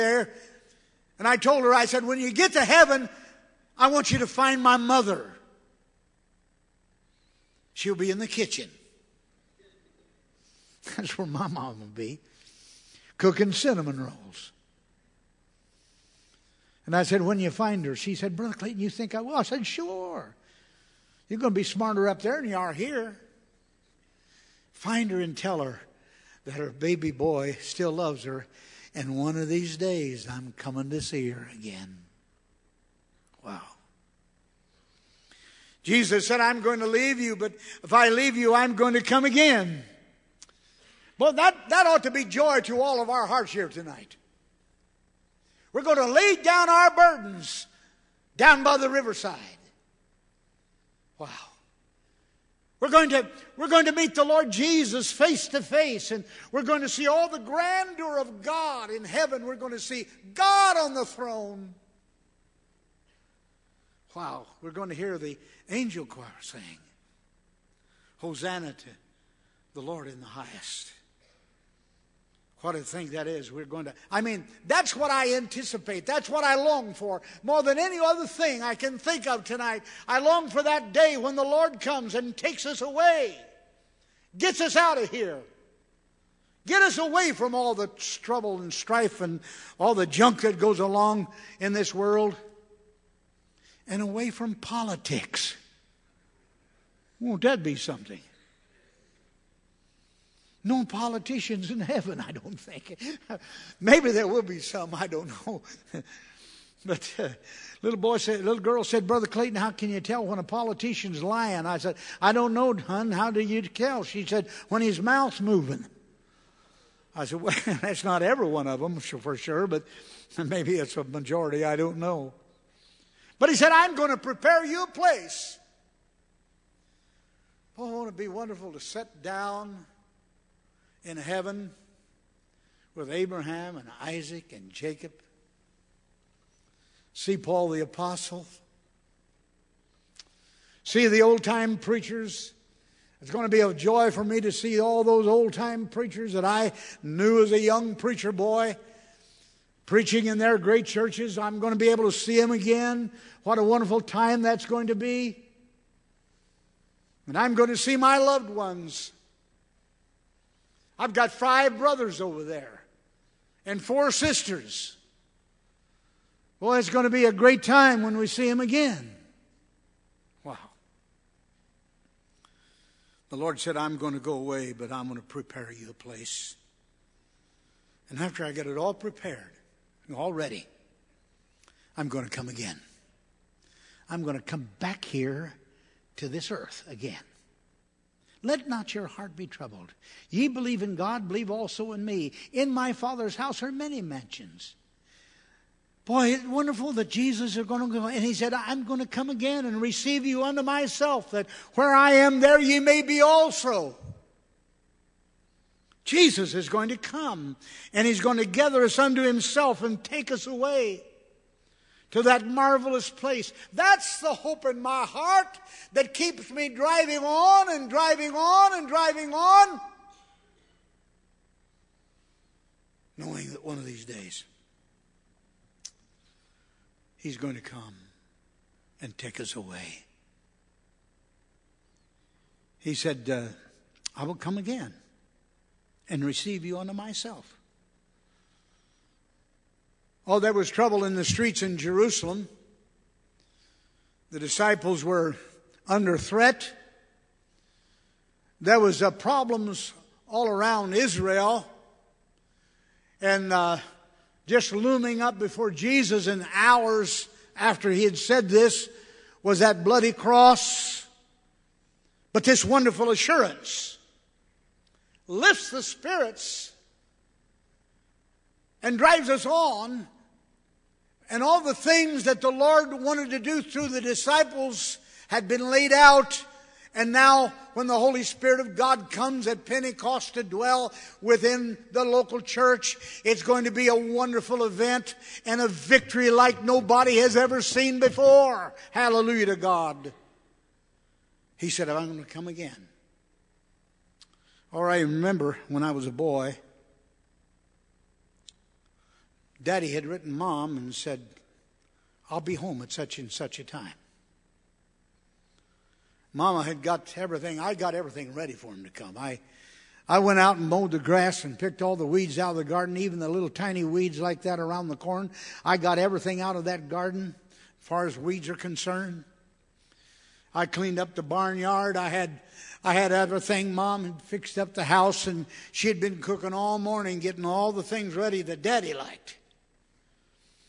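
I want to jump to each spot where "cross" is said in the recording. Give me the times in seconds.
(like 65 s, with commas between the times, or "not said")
260 s.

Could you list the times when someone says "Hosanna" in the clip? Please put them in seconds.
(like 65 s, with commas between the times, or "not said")
68 s.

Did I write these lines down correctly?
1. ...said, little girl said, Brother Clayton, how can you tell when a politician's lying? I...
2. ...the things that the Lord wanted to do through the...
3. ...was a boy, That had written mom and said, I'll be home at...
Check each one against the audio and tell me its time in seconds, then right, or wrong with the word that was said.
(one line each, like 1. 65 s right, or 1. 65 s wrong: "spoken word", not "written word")
1. 108 s right
2. 271 s right
3. 295 s wrong: "Daddy", not "That".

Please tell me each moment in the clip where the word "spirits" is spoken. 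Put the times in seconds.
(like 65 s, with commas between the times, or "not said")
265 s, 278 s.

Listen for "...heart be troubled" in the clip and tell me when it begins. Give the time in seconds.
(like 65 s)
189 s.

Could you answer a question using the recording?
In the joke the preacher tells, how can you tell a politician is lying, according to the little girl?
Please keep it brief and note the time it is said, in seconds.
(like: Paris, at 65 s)
when his mouth's moving, at 114 s.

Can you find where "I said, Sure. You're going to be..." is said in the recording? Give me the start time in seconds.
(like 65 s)
19 s.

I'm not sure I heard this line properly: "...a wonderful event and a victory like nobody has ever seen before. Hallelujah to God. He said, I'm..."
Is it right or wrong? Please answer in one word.
right.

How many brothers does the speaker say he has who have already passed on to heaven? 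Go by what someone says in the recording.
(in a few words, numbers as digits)
5.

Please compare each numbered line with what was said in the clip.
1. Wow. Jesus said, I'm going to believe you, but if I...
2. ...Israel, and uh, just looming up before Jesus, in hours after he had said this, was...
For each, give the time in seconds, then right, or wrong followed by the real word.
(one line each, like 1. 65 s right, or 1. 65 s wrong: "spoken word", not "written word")
1. 33 s wrong: "leave", not "believe"
2. 250 s right.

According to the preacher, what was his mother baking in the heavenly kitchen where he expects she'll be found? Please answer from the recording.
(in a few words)
cinnamon rolls.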